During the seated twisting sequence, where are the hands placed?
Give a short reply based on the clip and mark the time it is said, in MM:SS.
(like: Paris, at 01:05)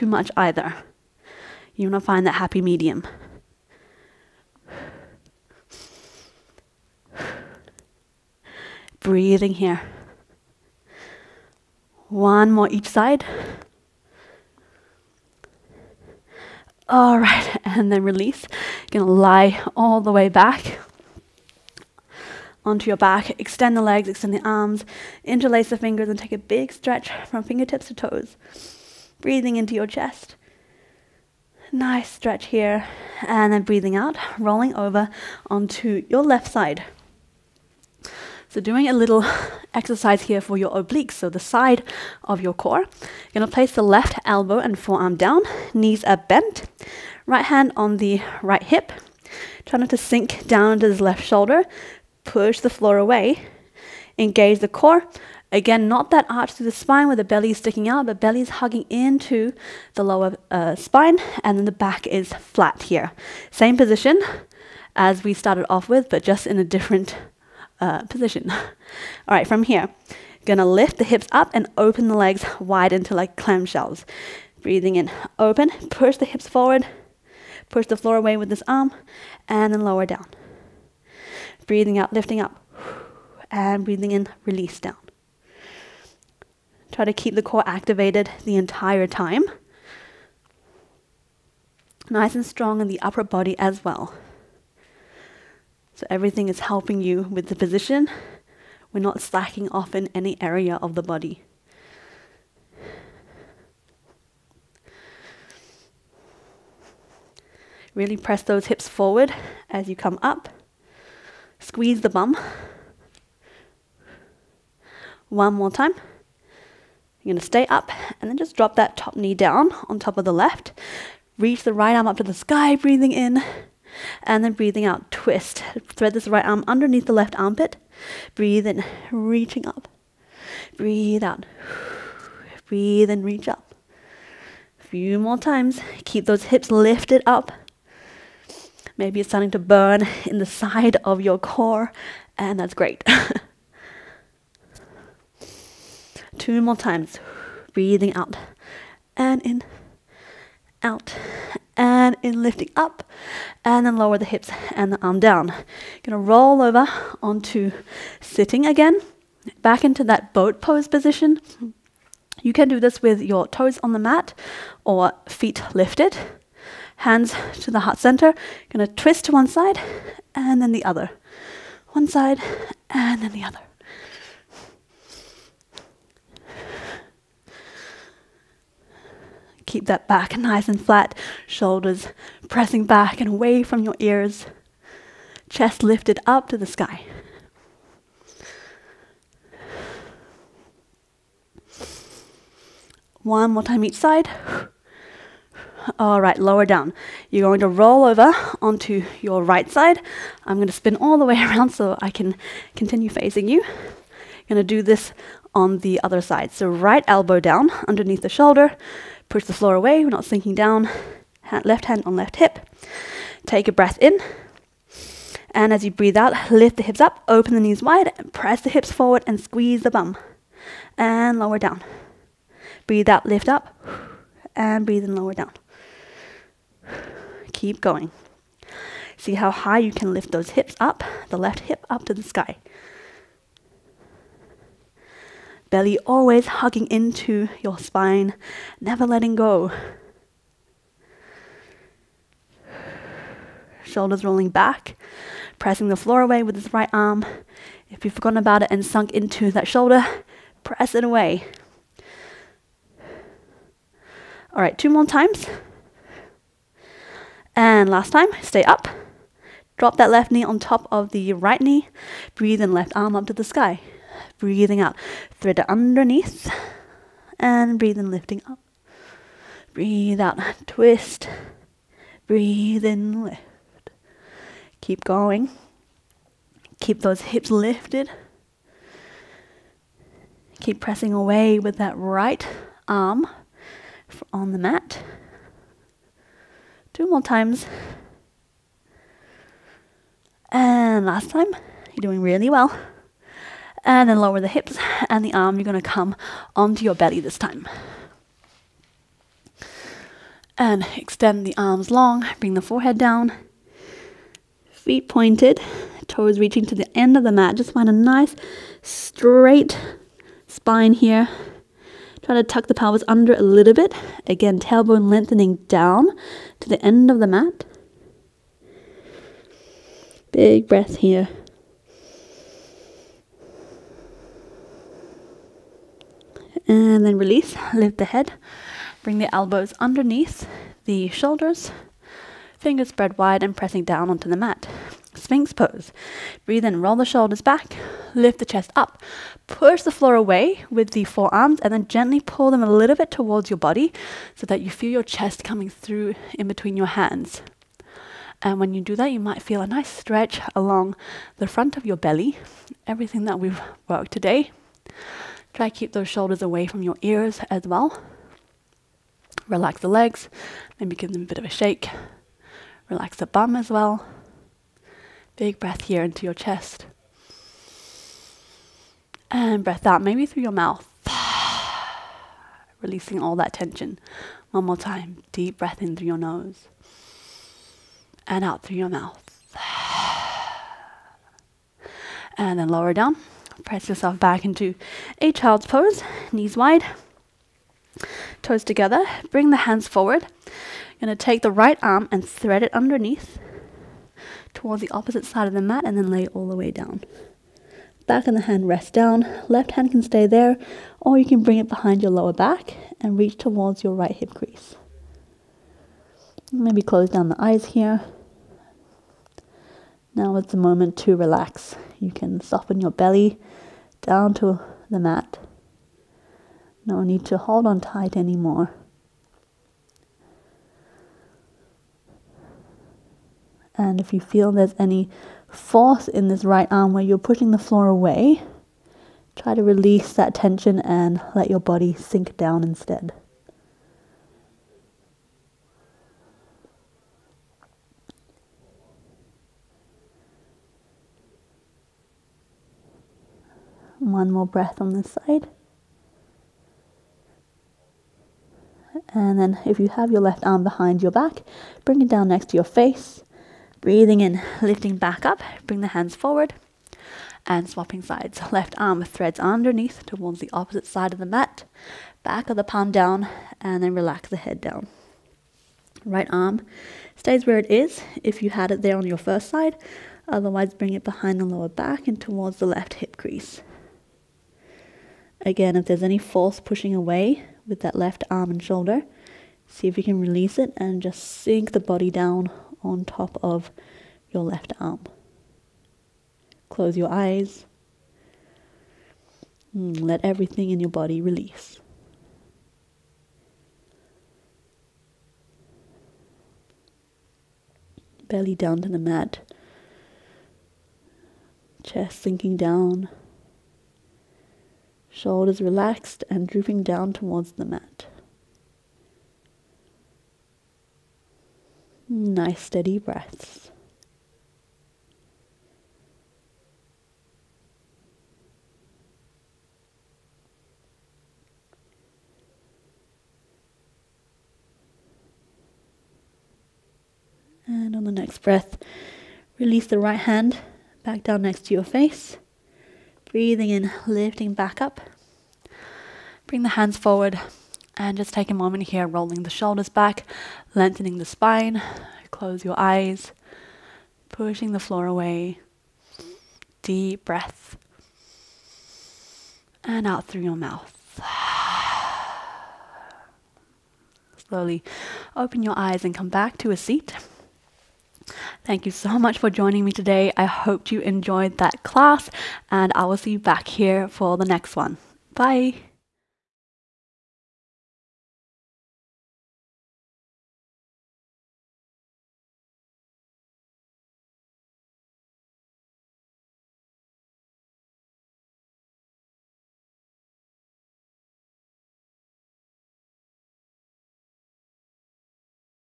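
Heart center, at 02:47.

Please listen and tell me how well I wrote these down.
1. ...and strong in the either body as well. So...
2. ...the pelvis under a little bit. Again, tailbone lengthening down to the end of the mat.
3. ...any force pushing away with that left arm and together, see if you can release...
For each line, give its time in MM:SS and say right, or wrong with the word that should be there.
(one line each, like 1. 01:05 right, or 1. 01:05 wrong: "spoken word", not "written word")
1. 01:32 wrong: "upper", not "either"
2. 05:12 right
3. 07:56 wrong: "shoulder", not "together".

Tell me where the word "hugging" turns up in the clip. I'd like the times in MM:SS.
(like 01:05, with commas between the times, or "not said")
00:58, 03:56.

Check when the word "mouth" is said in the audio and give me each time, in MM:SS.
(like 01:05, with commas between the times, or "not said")
06:10, 06:18, 09:10.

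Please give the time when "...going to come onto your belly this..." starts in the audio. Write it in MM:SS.
04:55.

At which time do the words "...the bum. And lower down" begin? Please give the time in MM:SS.
03:39.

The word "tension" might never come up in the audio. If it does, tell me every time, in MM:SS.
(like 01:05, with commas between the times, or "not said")
06:13, 07:10.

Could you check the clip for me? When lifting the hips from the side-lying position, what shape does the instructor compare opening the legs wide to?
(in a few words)
Clamshells.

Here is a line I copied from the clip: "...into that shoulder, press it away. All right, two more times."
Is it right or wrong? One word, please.
right.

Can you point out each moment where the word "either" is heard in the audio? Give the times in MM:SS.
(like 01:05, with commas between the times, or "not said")
00:00.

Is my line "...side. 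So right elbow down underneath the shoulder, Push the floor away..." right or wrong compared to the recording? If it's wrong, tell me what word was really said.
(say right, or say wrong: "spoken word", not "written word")
right.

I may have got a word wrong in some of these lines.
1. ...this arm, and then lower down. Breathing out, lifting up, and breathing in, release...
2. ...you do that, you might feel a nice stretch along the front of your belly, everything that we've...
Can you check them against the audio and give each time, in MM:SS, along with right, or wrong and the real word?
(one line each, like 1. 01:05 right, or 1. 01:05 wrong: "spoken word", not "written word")
1. 01:18 right
2. 05:48 right.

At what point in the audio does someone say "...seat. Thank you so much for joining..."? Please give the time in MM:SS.
09:16.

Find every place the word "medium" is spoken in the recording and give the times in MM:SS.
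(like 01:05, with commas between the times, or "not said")
00:02.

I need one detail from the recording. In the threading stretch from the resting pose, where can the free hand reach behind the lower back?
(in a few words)
Right hip crease.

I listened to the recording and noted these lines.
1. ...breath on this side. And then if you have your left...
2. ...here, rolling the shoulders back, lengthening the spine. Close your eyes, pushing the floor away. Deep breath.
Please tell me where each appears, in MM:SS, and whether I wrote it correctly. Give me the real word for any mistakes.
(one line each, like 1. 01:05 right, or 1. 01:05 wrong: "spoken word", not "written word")
1. 07:24 right
2. 08:58 right.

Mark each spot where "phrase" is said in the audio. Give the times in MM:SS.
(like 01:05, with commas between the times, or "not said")
not said.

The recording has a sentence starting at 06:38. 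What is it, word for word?
Back and the hand rests down.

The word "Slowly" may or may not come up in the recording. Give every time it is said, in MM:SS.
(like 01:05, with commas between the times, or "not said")
09:14.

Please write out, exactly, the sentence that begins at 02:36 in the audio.
Gonna roll over onto sitting again, back into that boat pose position.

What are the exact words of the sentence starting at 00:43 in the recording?
You're gonna place the left elbow and forearm down, knees are bent, right hand on the right hip.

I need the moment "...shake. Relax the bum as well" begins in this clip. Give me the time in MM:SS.
06:01.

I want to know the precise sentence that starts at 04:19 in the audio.
Drop that left knee on top of the right knee.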